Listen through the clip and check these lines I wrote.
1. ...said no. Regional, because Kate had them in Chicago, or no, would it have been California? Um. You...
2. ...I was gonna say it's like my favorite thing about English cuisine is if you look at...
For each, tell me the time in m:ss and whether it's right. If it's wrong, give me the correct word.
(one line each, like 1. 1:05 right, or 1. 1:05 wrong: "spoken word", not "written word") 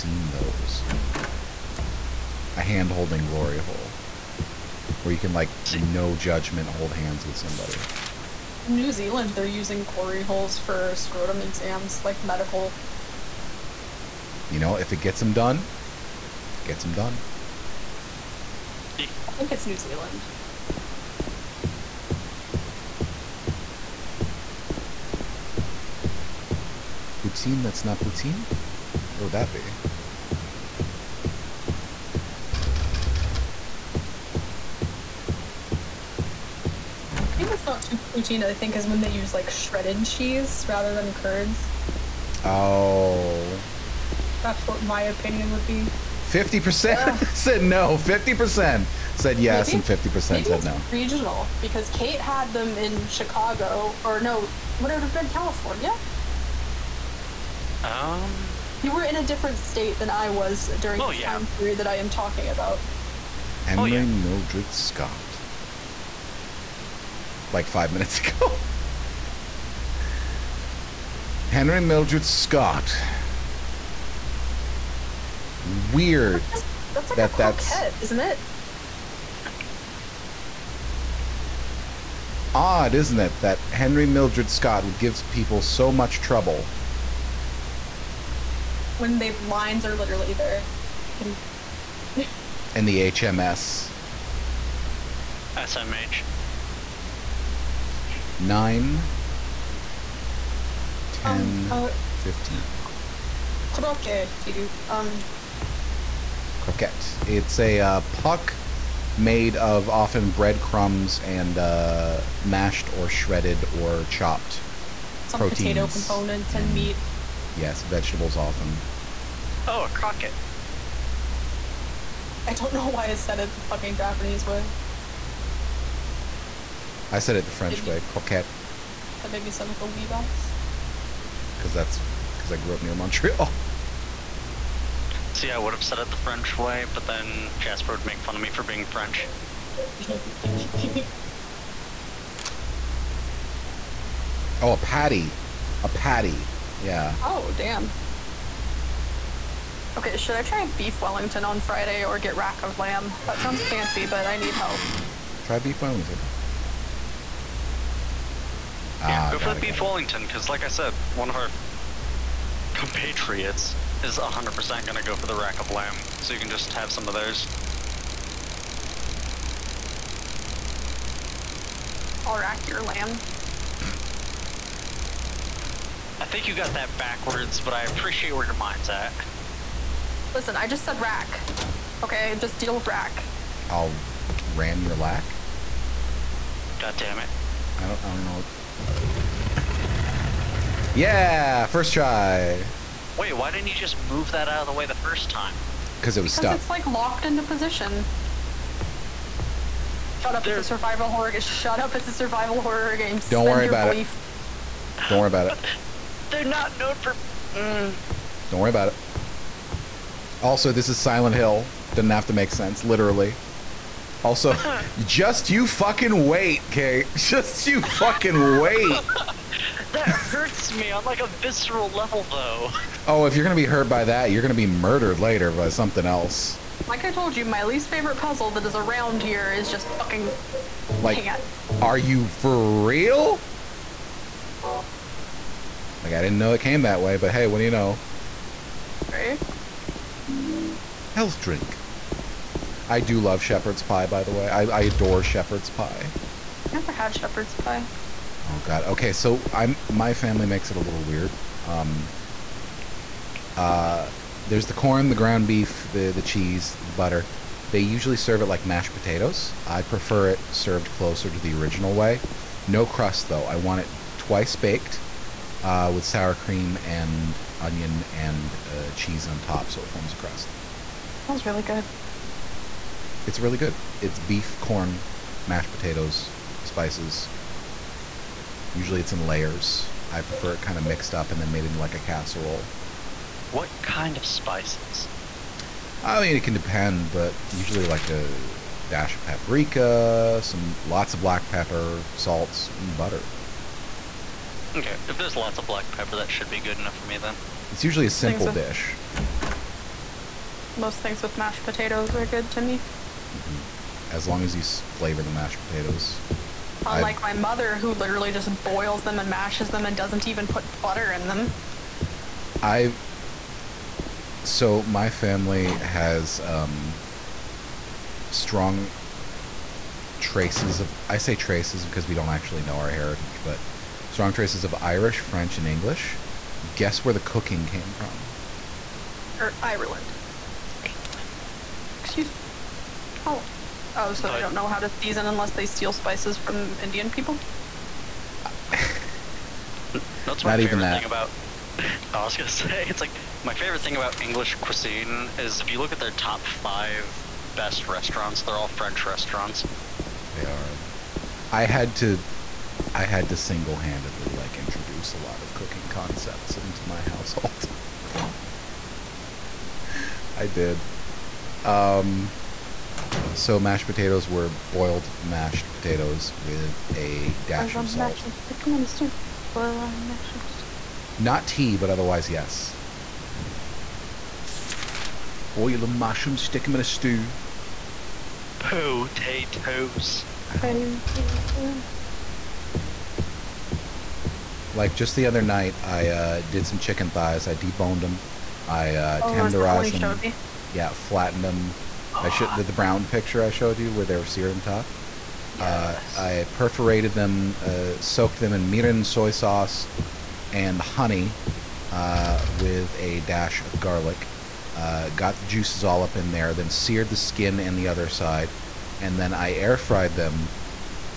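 1. 0:50 right
2. 5:42 right.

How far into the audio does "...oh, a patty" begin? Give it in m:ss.
2:24.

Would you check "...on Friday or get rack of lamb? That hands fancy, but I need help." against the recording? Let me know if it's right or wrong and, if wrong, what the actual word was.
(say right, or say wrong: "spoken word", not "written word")
wrong: "sounds", not "hands".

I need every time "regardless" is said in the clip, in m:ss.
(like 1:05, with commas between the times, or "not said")
not said.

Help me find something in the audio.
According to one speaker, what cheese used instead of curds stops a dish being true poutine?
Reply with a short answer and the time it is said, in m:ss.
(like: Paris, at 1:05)
shredded cheese, at 0:39.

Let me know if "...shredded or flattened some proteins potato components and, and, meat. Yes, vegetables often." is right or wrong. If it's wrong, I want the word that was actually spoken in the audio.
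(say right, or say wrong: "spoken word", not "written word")
wrong: "chopped", not "flattened".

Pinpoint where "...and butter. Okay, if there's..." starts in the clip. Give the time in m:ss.
4:52.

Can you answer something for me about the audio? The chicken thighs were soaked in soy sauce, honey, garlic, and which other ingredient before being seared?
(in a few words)
mirin.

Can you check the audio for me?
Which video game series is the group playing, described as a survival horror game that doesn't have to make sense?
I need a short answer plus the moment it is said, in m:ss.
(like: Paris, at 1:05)
Silent Hill, at 3:30.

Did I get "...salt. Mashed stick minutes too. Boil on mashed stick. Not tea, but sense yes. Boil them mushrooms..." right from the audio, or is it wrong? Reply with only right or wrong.
wrong.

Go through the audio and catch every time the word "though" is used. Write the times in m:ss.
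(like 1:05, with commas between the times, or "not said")
3:42, 4:23.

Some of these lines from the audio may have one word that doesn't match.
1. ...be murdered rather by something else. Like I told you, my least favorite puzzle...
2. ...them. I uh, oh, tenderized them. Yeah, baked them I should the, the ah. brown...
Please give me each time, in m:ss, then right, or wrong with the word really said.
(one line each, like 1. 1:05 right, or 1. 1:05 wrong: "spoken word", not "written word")
1. 3:44 wrong: "later", not "rather"
2. 6:28 wrong: "flattened", not "baked".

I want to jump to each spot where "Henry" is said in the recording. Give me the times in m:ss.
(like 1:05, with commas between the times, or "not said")
1:03, 1:11, 1:23.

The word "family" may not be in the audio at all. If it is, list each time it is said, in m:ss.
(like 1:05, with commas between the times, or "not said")
4:10, 5:15.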